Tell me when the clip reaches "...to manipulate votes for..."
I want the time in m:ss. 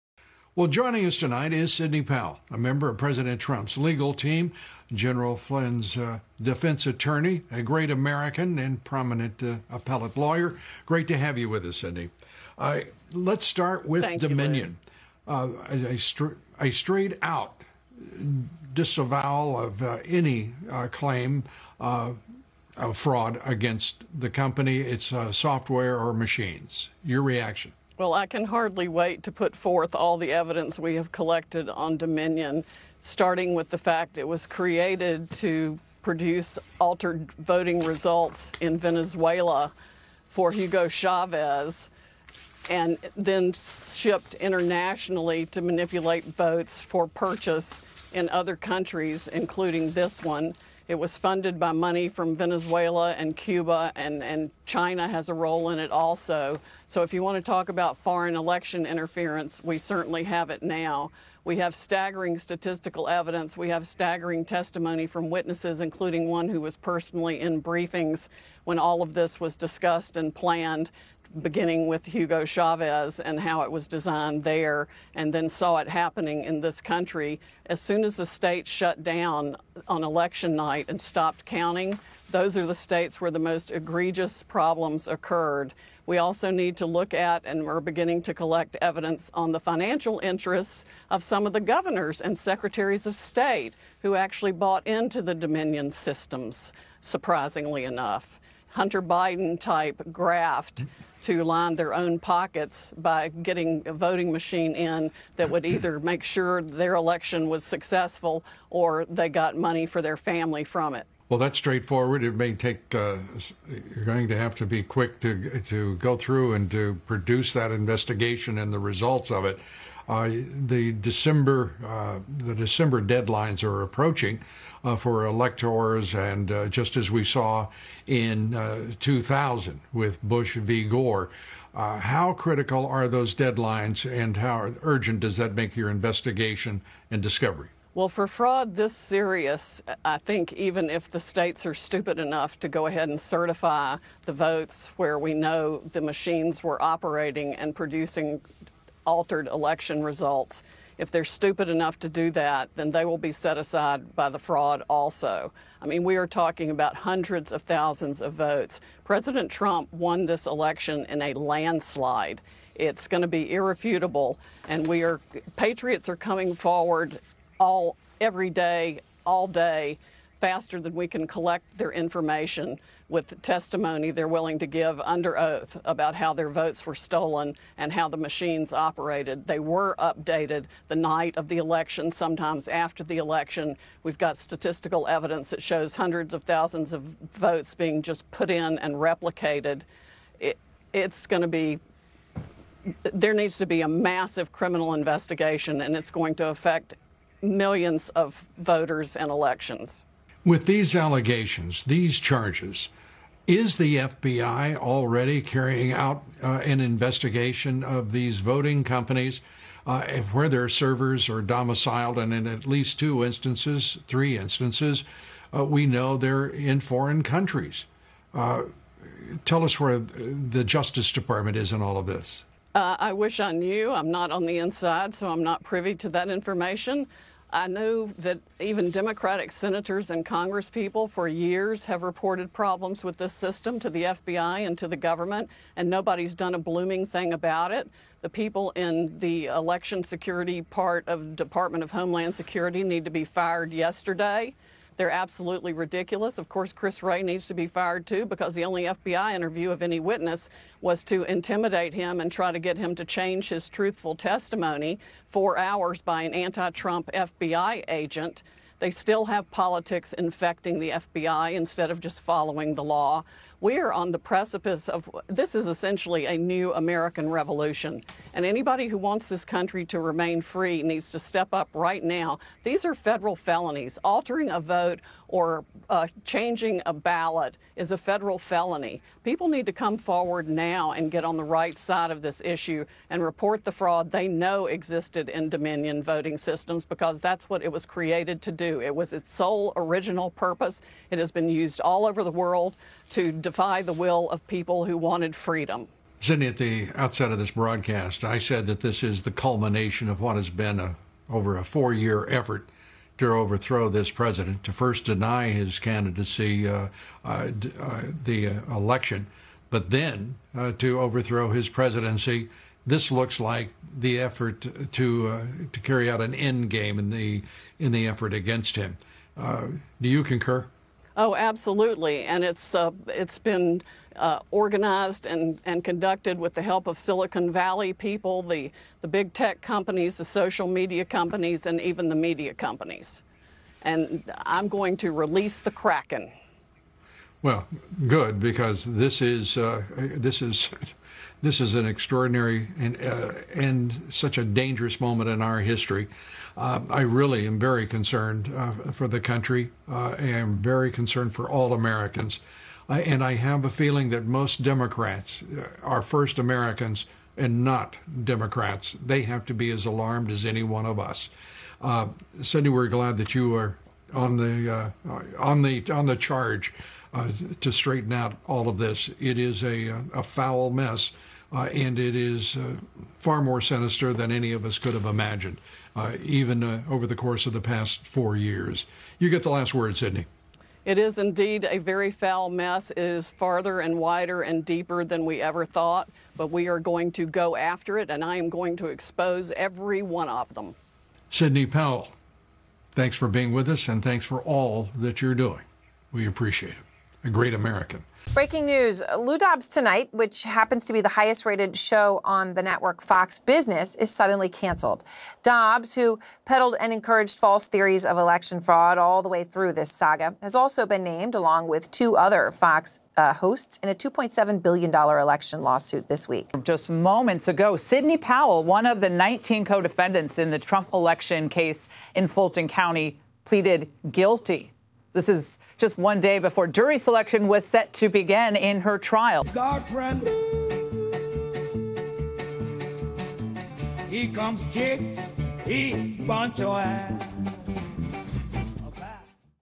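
0:45.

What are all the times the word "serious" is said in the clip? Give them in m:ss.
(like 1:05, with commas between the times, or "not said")
2:18.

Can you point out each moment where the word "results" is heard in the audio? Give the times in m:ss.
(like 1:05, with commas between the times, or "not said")
0:37, 1:58, 2:30.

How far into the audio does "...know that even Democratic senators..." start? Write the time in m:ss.
3:47.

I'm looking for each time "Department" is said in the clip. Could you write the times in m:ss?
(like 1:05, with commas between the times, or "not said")
3:41, 4:01.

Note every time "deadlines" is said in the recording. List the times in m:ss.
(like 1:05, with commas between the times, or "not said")
2:03, 2:13.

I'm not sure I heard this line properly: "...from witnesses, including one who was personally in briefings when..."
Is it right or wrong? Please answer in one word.
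right.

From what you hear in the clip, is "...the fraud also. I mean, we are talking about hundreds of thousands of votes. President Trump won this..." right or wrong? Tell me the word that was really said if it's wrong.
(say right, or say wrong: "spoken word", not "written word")
right.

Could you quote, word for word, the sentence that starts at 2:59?
They were updated the night of the election, sometimes after the election.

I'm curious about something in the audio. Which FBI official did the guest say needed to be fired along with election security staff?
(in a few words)
Chris Wray.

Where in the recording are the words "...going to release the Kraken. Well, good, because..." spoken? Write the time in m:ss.
5:34.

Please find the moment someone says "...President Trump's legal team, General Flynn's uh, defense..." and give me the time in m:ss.
0:02.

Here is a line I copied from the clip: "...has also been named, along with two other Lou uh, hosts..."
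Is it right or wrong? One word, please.
wrong.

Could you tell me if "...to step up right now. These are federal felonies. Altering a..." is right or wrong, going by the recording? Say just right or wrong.
right.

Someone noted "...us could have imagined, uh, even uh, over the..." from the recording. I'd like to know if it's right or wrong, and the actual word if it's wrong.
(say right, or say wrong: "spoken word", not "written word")
right.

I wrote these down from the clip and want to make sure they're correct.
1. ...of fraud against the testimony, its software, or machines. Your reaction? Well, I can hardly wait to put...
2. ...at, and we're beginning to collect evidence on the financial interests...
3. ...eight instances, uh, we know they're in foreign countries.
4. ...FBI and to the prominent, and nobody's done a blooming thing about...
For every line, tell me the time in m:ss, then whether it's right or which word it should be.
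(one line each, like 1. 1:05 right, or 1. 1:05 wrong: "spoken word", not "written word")
1. 0:21 wrong: "company", not "testimony"
2. 1:27 right
3. 3:34 wrong: "three", not "eight"
4. 3:54 wrong: "government", not "prominent".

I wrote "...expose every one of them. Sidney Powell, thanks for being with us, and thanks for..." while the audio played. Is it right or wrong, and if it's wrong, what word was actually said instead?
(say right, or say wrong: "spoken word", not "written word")
right.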